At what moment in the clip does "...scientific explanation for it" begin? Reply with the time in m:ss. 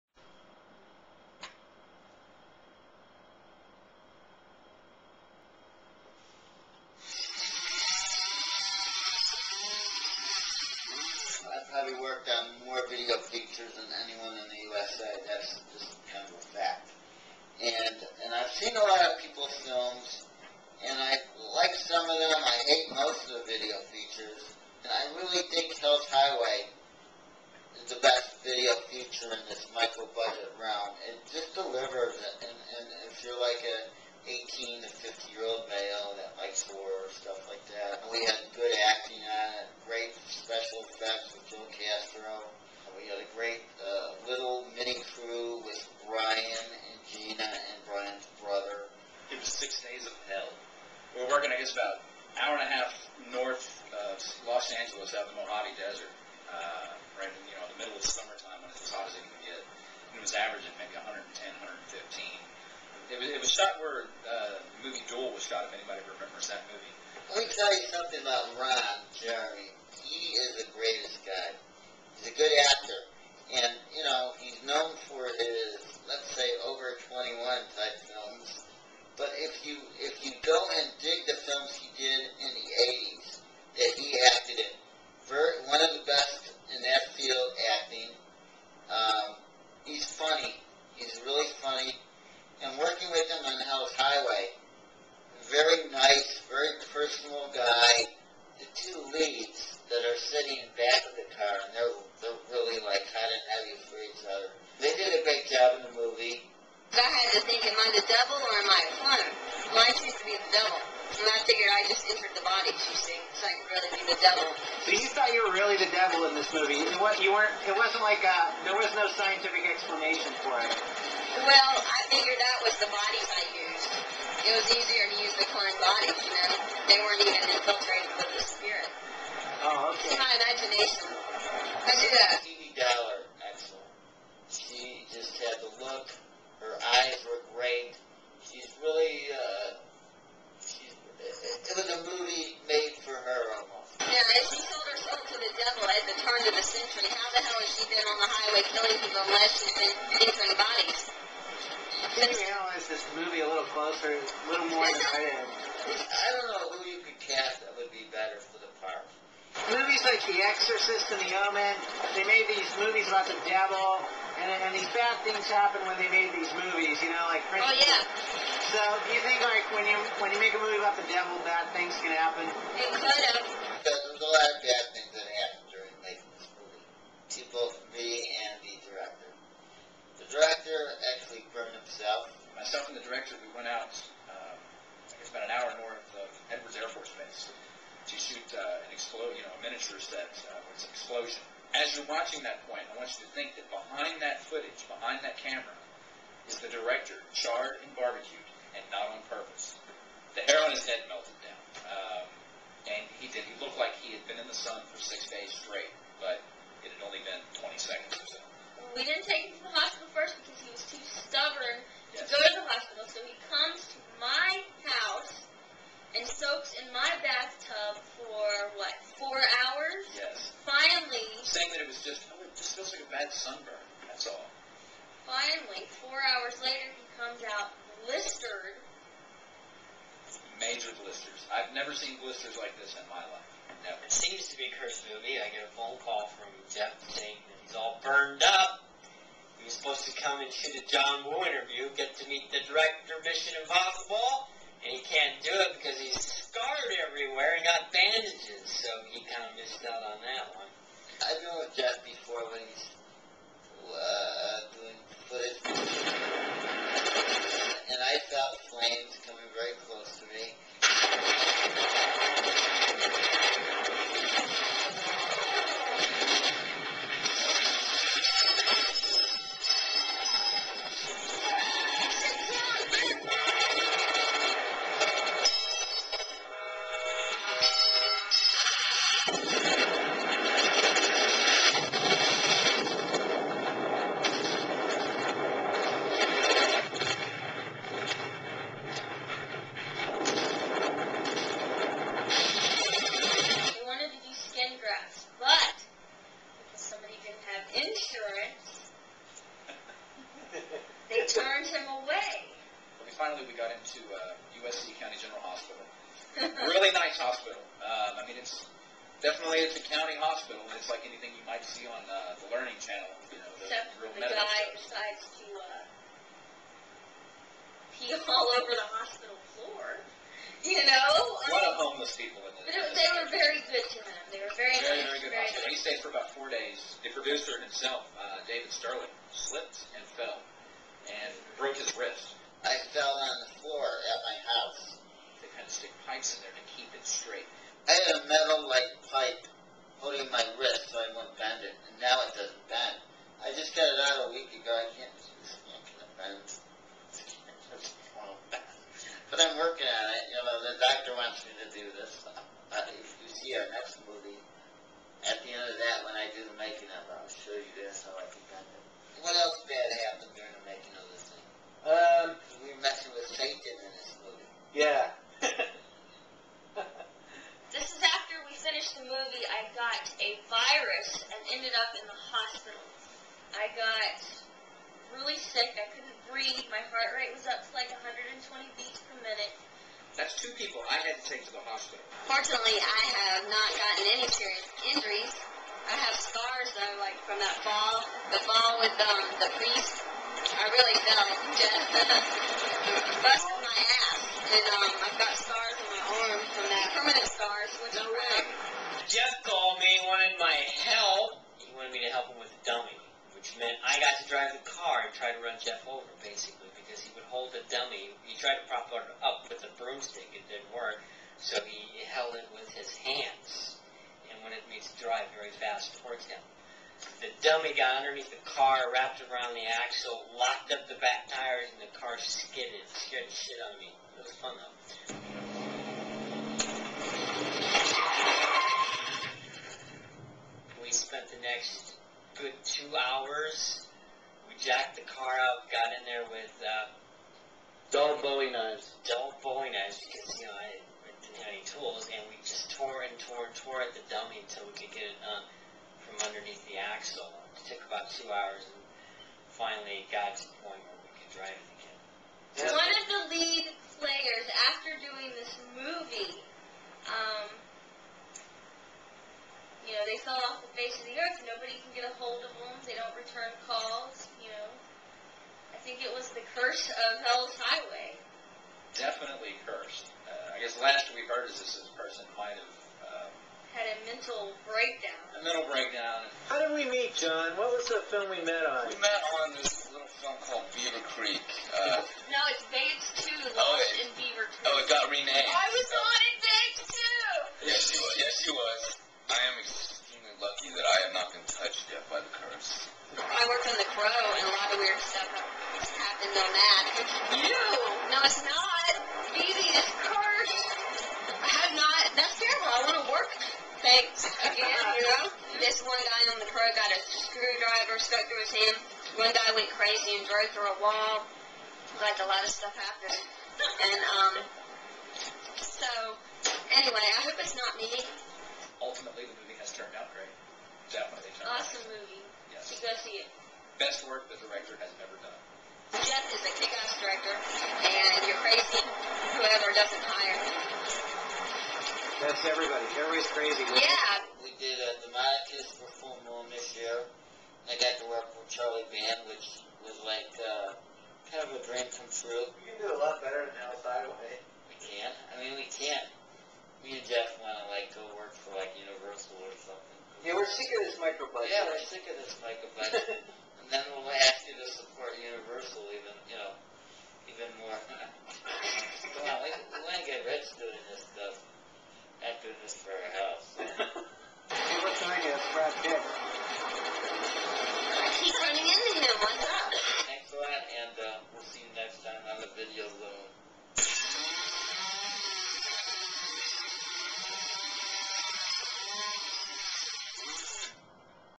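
1:59.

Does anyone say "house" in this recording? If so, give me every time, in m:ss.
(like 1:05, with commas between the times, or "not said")
3:34, 5:34, 9:23.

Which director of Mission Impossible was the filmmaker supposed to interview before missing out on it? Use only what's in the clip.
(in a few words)
John Woo.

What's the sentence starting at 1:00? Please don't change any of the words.
And it was averaging maybe 110, 115.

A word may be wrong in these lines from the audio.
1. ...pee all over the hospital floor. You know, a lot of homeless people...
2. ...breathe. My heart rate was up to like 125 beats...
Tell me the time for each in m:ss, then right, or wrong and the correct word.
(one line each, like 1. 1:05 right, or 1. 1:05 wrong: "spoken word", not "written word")
1. 5:17 right
2. 6:16 wrong: "120", not "125".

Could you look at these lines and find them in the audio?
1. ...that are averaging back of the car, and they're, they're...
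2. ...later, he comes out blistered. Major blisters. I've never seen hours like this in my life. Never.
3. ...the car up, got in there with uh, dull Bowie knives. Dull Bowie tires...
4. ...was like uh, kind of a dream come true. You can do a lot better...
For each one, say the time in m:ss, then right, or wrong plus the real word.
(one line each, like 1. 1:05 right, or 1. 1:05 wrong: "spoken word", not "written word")
1. 1:39 wrong: "sitting", not "averaging"
2. 3:46 wrong: "blisters", not "hours"
3. 7:14 wrong: "knives", not "tires"
4. 8:59 right.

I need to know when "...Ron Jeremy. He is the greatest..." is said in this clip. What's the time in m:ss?
1:08.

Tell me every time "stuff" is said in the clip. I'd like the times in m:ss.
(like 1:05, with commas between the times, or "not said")
0:37, 8:32, 9:21.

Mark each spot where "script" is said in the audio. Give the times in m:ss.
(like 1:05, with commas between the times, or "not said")
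not said.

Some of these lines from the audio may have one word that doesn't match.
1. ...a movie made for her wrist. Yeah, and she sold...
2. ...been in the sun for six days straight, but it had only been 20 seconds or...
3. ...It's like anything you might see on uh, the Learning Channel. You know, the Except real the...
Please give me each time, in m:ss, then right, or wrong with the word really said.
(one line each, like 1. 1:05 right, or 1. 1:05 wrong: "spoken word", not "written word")
1. 2:21 wrong: "almost", not "wrist"
2. 3:24 right
3. 5:10 right.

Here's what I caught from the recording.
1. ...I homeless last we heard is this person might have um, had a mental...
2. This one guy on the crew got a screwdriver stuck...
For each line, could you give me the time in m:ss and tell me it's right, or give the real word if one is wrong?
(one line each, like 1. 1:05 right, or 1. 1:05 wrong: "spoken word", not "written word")
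1. 7:50 wrong: "guess", not "homeless"
2. 8:25 right.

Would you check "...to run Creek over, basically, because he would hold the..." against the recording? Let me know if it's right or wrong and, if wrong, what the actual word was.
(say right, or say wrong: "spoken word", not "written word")
wrong: "Jeff", not "Creek".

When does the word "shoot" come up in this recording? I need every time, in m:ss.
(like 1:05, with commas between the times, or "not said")
3:08, 4:00.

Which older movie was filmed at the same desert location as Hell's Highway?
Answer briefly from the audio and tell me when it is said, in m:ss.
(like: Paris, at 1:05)
Duel, at 1:05.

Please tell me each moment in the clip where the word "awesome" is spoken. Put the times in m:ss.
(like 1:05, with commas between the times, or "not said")
8:41.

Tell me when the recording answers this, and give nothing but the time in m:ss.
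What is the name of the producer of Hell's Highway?
5:28.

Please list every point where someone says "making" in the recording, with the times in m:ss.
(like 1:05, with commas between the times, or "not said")
2:56, 5:56, 6:00.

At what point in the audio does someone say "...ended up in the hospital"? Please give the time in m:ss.
6:11.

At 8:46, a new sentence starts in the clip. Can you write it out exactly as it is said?
Jeff is a kick-ass director, and you're crazy whoever doesn't hire him.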